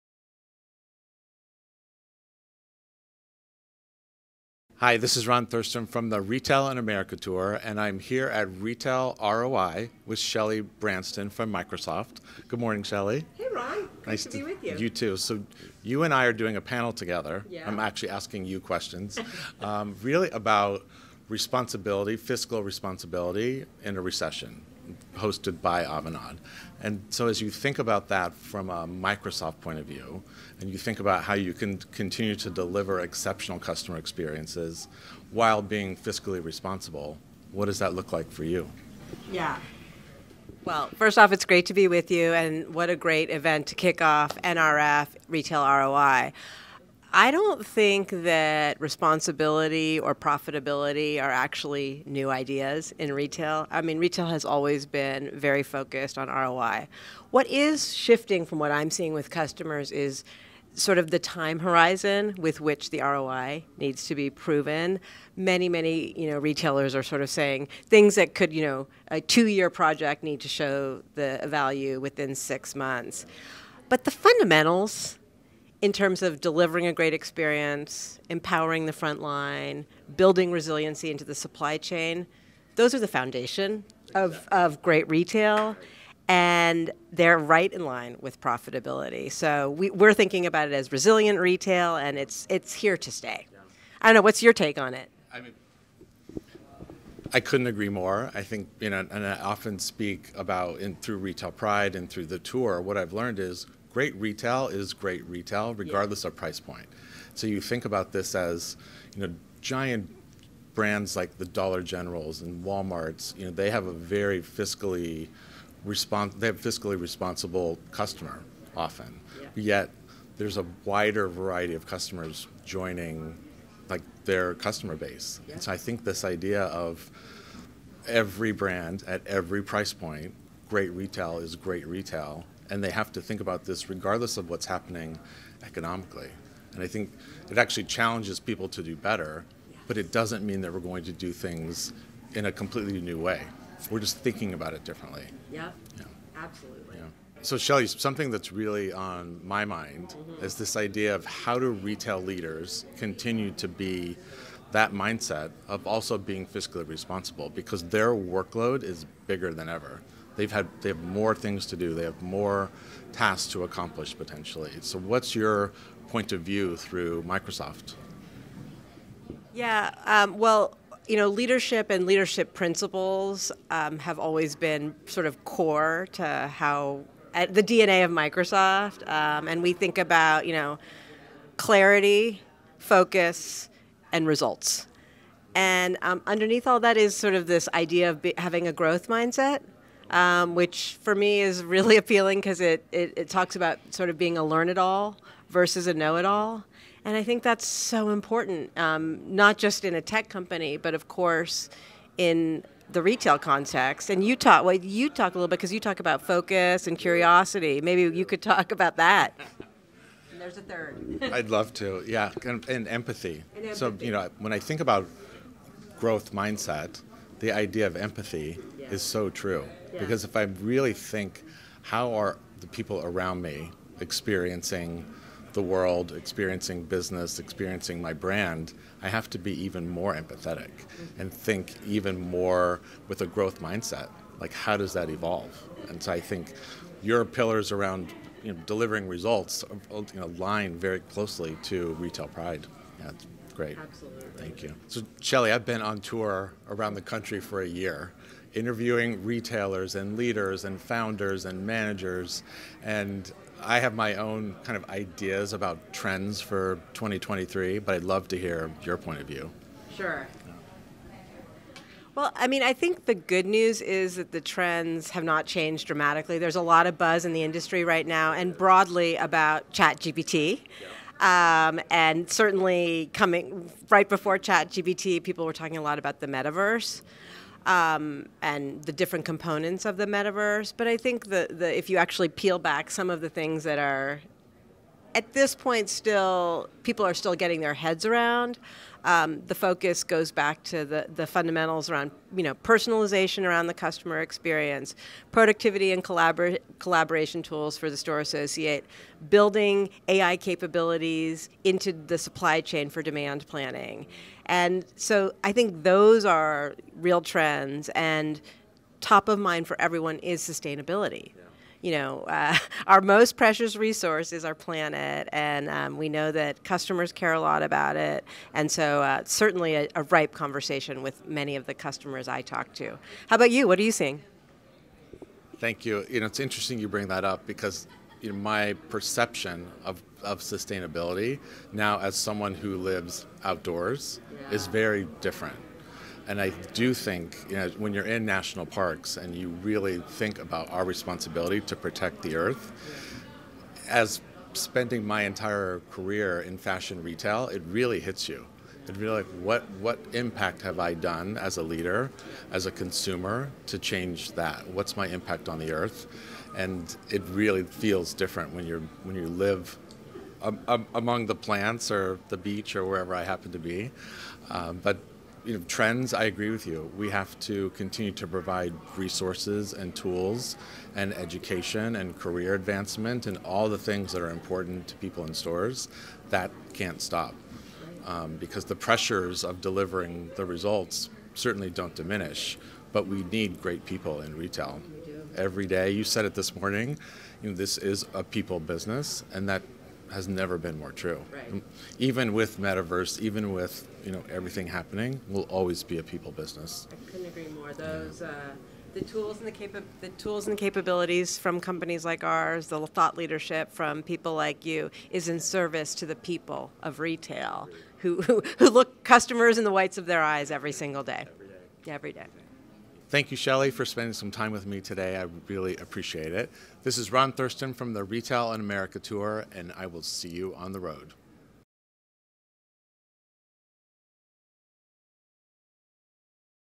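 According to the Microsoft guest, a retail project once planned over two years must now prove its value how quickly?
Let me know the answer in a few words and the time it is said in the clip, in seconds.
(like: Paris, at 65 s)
6 months, at 72 s.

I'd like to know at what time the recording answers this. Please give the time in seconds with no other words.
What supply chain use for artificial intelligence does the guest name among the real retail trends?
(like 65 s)
303 s.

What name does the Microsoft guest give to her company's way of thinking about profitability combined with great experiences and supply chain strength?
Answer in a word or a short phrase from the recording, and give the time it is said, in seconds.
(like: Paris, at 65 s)
resilient retail, at 90 s.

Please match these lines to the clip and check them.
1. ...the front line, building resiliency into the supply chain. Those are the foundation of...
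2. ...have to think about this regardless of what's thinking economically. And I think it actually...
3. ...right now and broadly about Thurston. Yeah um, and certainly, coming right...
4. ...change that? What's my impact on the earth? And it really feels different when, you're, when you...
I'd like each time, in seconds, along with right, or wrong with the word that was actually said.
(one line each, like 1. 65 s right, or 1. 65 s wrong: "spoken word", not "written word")
1. 78 s right
2. 132 s wrong: "happening", not "thinking"
3. 267 s wrong: "ChatGPT", not "Thurston"
4. 353 s right.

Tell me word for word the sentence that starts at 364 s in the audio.
Um, but you know, trends, I agree with you.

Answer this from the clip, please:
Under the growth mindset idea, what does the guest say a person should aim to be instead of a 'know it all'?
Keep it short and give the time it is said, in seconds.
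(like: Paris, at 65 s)
a learn it all, at 194 s.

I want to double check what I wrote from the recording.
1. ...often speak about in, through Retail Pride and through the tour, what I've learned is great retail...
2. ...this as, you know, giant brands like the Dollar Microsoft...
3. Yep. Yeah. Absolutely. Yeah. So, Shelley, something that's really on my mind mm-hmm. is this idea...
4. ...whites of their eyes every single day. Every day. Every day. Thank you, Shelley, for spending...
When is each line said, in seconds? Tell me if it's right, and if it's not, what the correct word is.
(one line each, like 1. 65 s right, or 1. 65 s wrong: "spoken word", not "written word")
1. 99 s right
2. 108 s wrong: "Generals", not "Microsoft"
3. 145 s right
4. 409 s right.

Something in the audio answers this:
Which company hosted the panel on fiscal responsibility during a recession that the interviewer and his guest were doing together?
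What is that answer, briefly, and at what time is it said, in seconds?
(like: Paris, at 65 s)
Avanade, at 25 s.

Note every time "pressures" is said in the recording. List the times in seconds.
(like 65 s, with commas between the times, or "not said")
378 s.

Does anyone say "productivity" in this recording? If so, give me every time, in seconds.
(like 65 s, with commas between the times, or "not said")
295 s.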